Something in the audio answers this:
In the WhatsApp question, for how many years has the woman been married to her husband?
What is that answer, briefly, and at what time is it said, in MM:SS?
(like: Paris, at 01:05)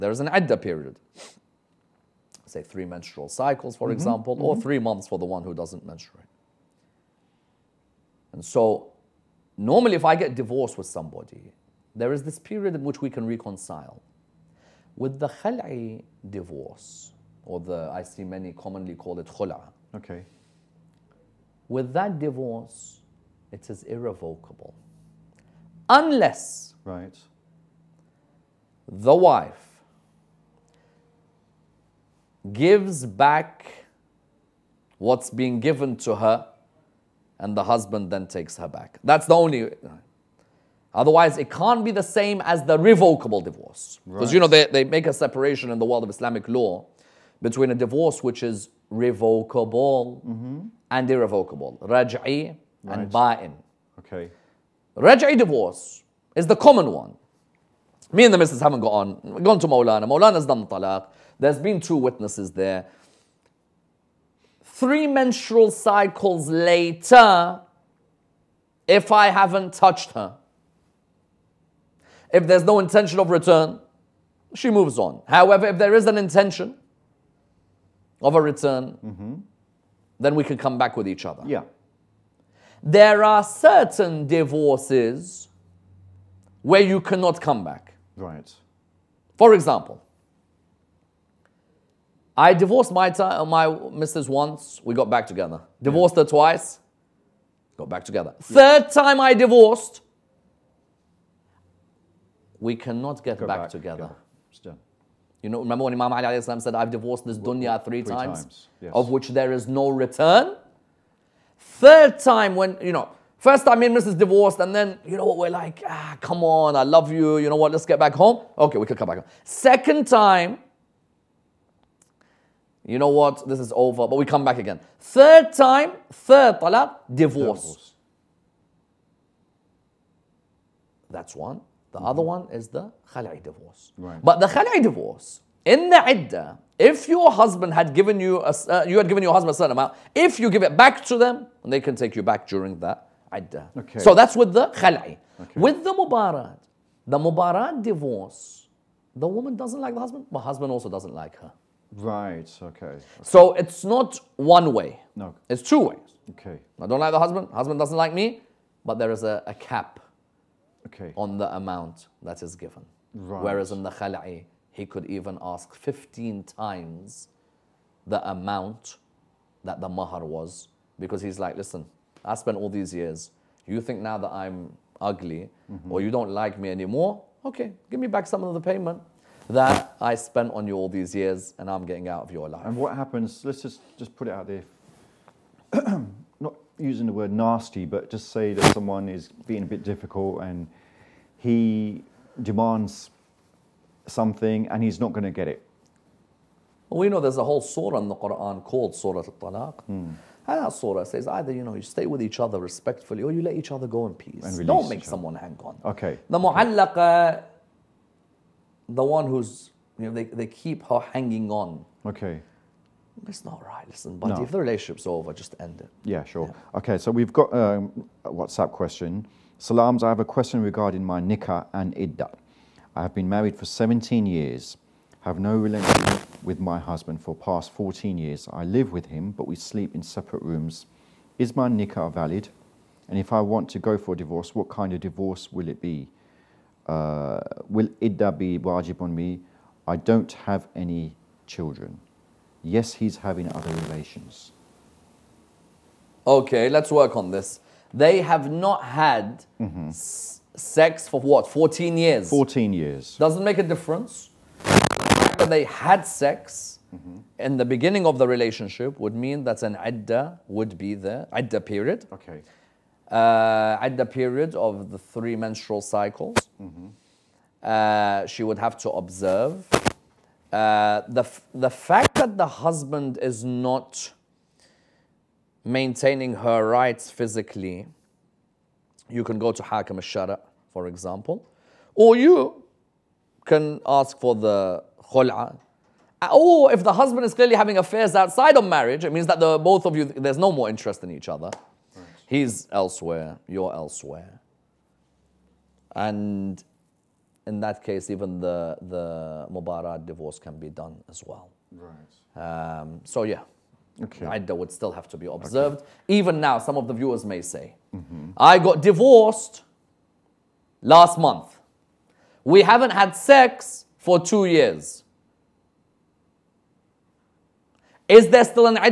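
17, at 03:43.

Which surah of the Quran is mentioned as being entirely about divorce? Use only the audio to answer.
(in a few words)
Surah Al Talaq.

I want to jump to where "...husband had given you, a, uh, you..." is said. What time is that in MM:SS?
02:17.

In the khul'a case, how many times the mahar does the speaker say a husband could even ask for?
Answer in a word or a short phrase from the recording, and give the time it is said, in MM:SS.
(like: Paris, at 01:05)
15, at 02:45.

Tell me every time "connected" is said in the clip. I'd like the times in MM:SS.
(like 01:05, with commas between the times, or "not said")
not said.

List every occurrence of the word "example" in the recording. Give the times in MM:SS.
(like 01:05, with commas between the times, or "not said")
00:03, 01:29, 04:40.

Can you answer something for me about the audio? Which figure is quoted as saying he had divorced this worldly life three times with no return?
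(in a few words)
Imam Ali.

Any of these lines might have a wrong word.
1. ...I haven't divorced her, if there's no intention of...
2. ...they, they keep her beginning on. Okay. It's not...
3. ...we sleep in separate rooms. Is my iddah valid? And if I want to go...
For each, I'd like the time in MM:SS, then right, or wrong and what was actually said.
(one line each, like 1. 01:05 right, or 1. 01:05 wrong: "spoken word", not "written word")
1. 01:09 wrong: "touched", not "divorced"
2. 03:30 wrong: "hanging", not "beginning"
3. 03:49 wrong: "nikah", not "iddah".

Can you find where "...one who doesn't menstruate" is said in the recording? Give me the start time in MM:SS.
00:05.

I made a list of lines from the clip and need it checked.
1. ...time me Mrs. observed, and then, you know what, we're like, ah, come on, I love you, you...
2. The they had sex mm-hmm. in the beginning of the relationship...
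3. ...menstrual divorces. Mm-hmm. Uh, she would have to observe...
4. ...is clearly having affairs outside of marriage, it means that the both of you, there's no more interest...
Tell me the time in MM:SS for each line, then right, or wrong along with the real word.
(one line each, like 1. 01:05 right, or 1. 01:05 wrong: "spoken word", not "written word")
1. 01:53 wrong: "divorced", not "observed"
2. 04:15 right
3. 04:25 wrong: "cycles", not "divorces"
4. 04:47 right.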